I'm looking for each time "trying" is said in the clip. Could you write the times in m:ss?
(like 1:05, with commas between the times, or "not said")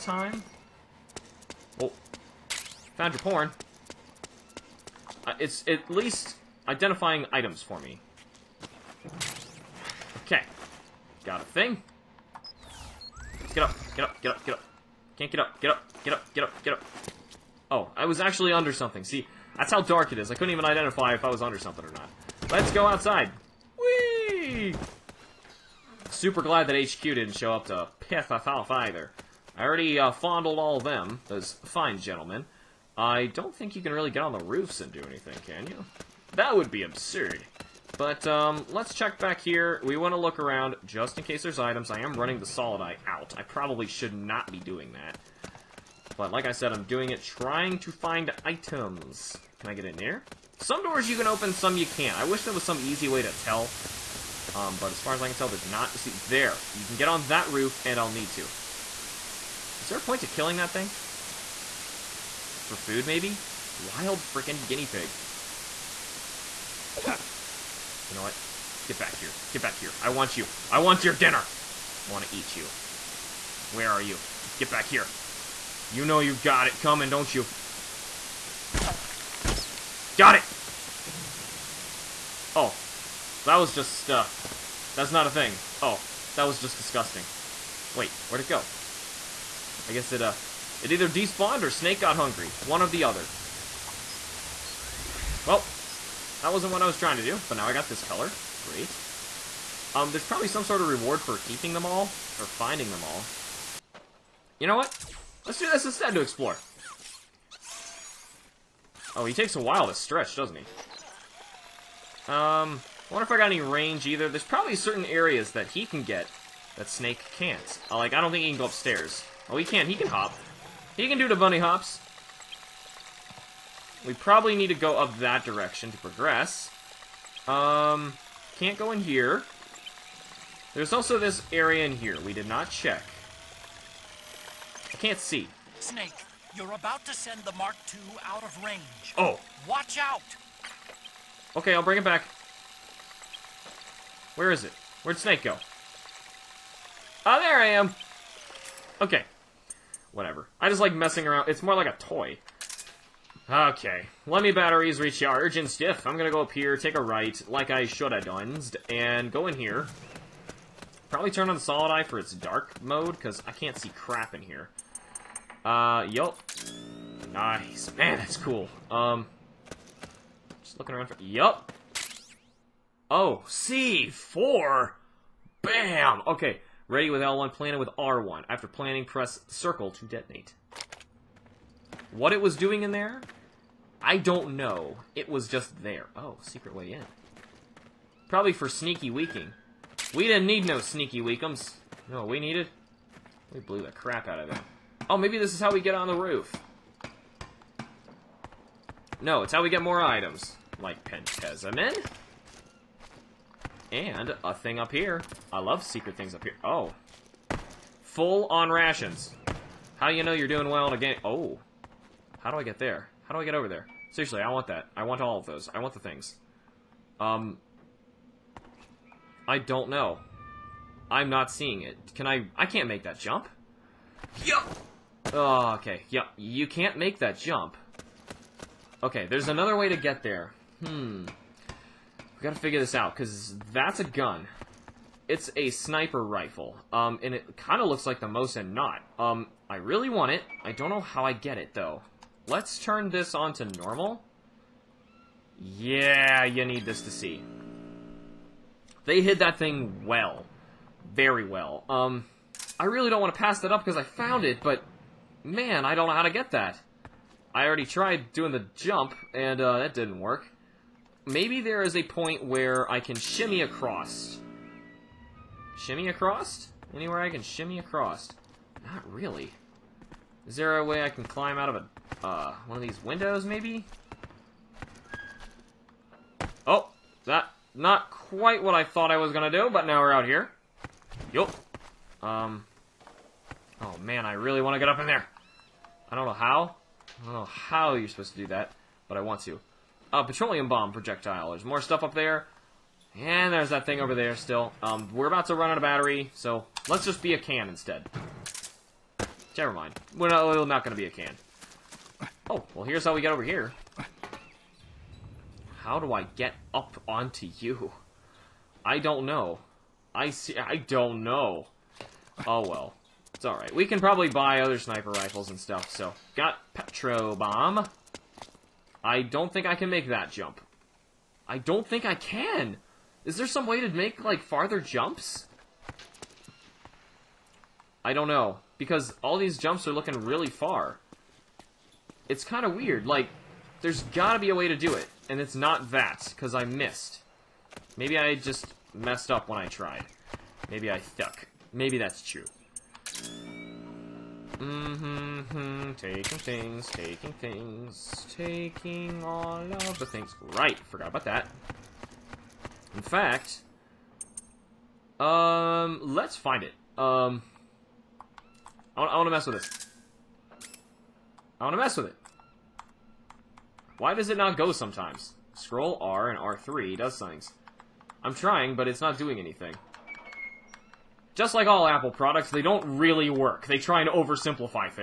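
0:47, 1:36, 6:08.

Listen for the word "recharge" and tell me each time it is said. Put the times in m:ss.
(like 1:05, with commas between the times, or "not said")
2:35.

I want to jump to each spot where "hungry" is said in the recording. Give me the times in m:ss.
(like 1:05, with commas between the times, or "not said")
1:32.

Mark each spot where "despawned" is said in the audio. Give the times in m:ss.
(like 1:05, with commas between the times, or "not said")
1:31.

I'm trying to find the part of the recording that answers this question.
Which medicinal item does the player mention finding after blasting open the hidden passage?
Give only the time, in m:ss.
3:21.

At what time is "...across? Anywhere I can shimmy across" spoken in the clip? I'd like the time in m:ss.
4:26.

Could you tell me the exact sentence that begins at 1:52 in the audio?
Um, I wonder if I got any range either.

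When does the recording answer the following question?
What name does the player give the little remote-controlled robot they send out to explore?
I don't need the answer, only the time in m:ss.
2:17.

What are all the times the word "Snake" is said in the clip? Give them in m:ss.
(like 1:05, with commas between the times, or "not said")
1:31, 1:56, 2:15, 2:25.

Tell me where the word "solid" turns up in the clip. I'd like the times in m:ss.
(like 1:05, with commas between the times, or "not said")
0:42, 2:41.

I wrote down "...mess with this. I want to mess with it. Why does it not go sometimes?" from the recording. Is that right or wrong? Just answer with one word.
right.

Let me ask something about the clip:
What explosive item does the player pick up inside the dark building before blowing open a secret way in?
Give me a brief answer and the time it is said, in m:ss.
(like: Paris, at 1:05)
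C4, at 2:53.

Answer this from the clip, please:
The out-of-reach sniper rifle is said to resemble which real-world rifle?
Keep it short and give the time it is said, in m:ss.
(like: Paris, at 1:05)
Mosin-Nagant, at 3:58.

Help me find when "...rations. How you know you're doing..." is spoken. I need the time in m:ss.
3:28.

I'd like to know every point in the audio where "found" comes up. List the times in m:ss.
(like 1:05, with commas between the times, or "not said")
0:02, 4:14.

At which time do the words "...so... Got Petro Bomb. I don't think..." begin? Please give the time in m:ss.
5:15.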